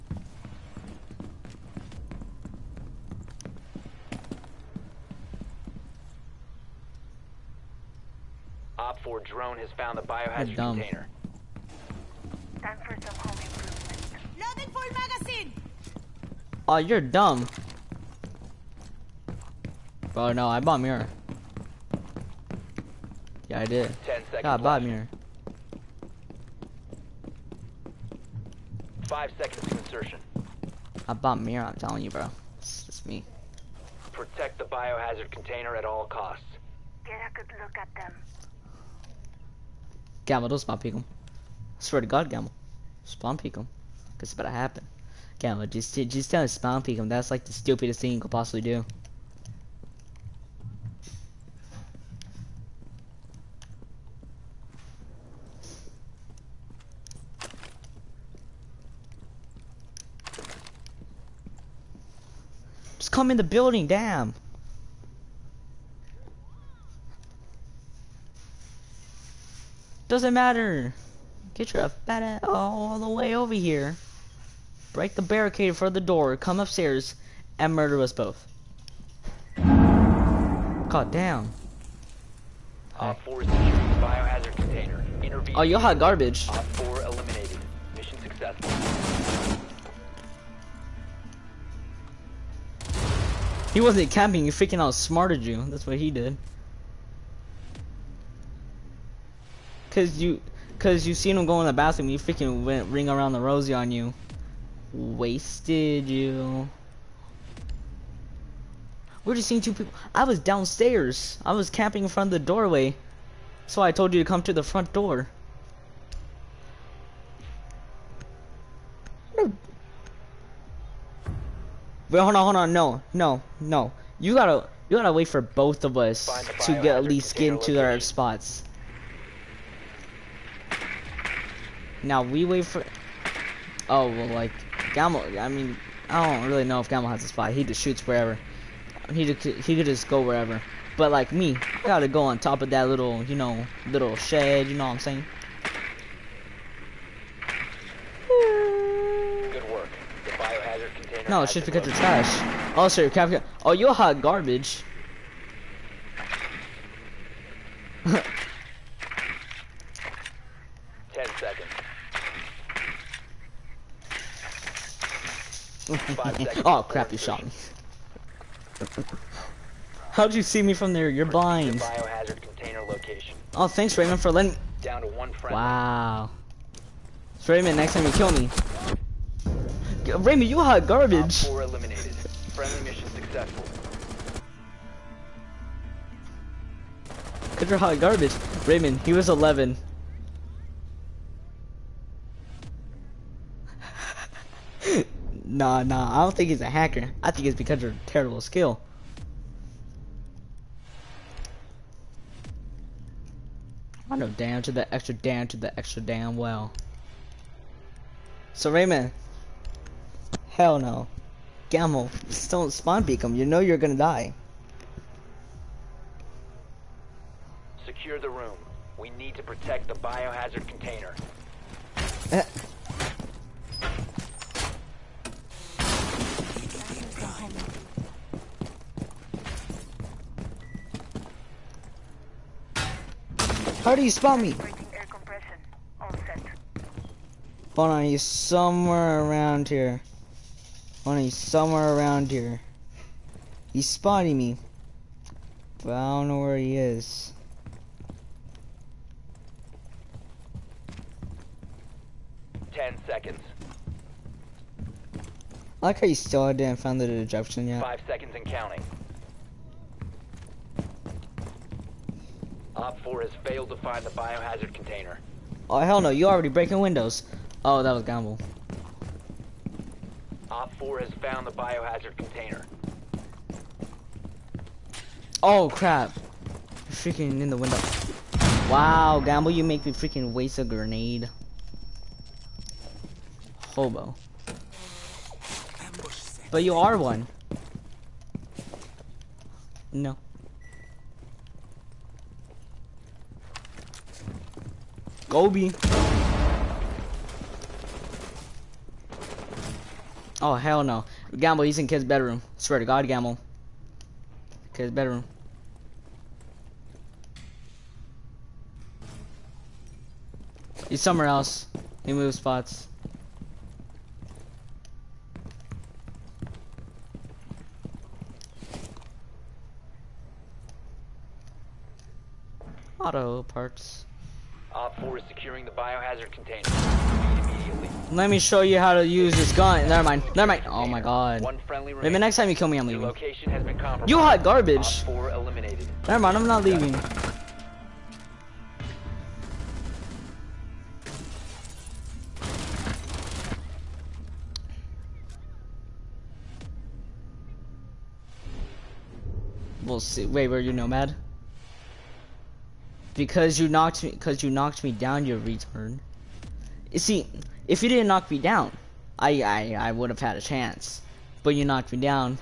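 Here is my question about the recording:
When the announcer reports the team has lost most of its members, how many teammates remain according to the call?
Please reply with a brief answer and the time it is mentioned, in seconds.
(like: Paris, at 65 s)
1, at 174 s.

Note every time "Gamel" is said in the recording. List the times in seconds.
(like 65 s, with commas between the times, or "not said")
211 s.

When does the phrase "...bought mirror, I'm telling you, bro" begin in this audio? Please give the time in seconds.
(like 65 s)
31 s.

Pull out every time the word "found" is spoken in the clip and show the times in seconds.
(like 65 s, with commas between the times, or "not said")
9 s, 271 s.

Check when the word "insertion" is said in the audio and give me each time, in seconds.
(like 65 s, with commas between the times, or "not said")
29 s.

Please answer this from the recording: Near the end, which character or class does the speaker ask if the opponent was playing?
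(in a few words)
Nomad.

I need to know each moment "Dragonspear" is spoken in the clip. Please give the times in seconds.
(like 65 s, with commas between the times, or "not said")
not said.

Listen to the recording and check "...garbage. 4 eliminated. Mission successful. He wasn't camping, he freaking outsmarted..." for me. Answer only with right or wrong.
right.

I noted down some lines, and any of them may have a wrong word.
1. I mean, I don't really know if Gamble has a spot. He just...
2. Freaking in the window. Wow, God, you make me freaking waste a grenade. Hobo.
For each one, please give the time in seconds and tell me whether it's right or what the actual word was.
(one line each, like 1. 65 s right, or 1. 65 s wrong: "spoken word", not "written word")
1. 135 s right
2. 276 s wrong: "Gamble", not "God".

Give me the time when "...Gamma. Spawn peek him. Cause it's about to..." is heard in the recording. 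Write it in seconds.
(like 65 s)
42 s.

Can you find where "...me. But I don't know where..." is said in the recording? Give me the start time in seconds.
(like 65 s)
244 s.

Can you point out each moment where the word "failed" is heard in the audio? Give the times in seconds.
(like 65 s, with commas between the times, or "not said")
263 s.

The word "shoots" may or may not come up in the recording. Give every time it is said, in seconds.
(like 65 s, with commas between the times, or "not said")
137 s.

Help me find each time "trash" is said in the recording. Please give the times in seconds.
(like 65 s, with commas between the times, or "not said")
151 s.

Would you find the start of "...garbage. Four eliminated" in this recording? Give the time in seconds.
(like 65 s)
180 s.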